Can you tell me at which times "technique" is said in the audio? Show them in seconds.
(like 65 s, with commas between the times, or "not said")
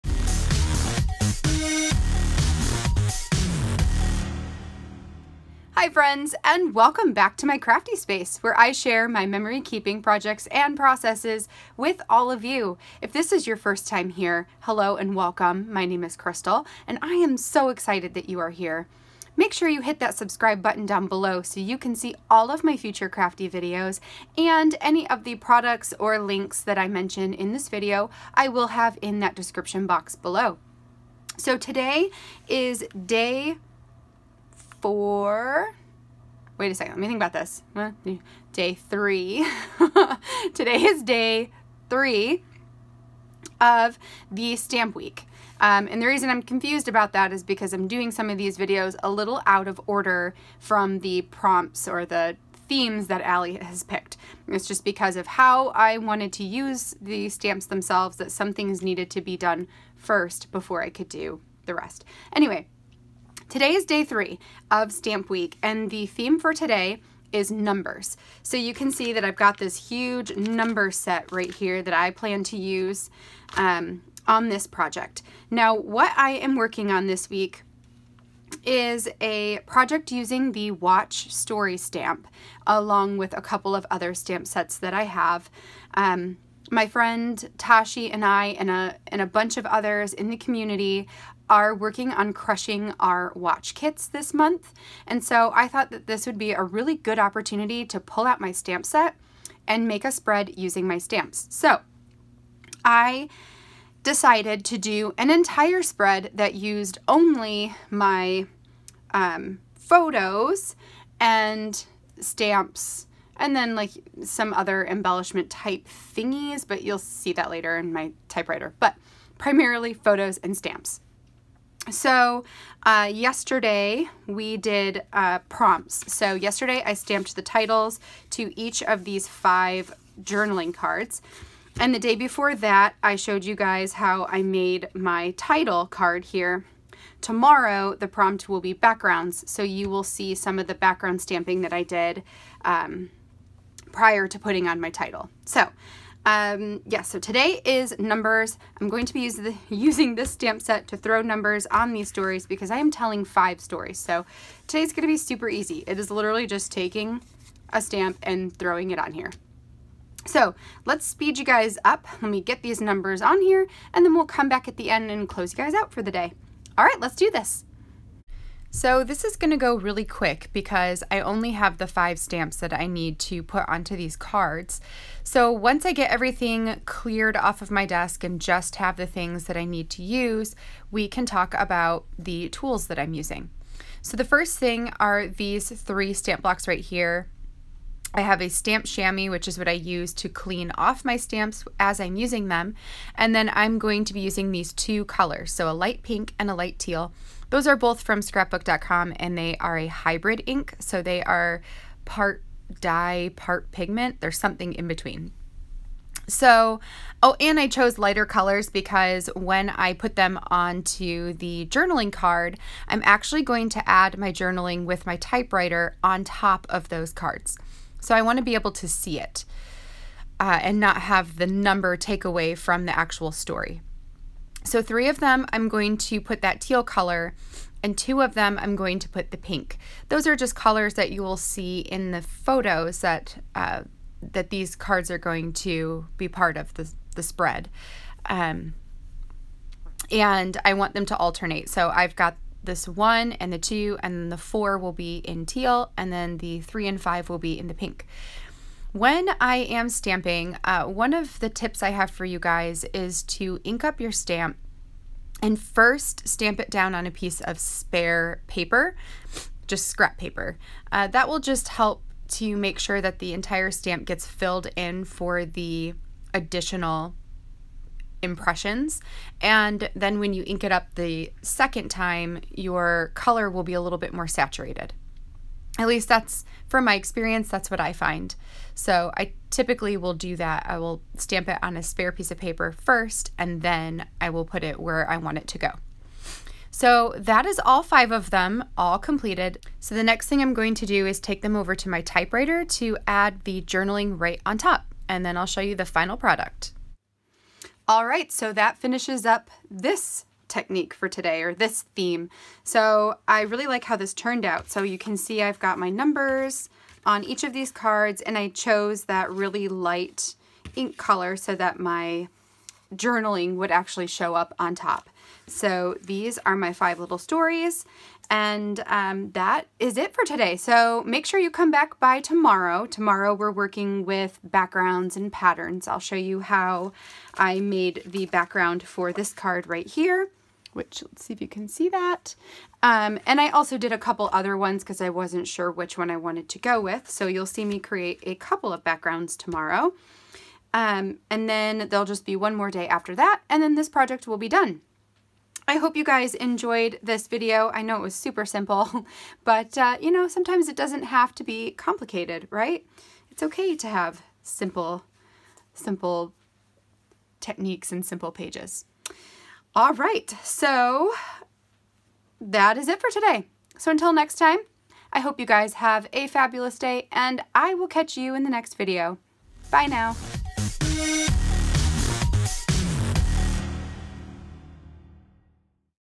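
300 s, 357 s.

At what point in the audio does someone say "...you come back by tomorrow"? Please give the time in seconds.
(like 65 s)
321 s.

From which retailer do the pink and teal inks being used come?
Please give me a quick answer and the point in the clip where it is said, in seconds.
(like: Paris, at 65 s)
scrapbook.com, at 198 s.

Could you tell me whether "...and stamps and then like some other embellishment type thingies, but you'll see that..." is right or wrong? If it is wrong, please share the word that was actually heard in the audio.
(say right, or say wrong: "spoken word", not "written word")
right.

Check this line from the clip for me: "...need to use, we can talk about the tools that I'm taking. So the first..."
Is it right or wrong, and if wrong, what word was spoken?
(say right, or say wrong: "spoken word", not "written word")
wrong: "using", not "taking".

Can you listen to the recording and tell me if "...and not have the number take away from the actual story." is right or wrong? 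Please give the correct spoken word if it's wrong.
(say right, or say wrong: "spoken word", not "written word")
right.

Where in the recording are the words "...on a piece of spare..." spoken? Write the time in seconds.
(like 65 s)
256 s.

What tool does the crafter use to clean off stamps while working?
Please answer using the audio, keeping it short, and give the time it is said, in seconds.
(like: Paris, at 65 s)
Stamp chamois, at 188 s.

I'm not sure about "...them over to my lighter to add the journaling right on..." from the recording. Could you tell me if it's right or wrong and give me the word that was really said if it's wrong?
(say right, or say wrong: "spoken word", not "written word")
wrong: "typewriter", not "lighter".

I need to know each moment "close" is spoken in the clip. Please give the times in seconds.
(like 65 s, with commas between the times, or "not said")
165 s.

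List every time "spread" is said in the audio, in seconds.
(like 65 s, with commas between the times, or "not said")
100 s, 105 s, 237 s.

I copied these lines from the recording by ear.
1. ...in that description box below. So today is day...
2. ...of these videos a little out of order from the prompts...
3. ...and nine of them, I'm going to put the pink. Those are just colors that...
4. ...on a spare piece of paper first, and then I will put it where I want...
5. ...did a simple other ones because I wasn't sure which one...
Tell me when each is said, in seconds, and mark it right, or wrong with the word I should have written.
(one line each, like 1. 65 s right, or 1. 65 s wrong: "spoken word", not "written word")
1. 29 s right
2. 48 s right
3. 227 s wrong: "two", not "nine"
4. 281 s right
5. 333 s wrong: "couple", not "simple".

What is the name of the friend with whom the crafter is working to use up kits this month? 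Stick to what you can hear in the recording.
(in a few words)
Tashi.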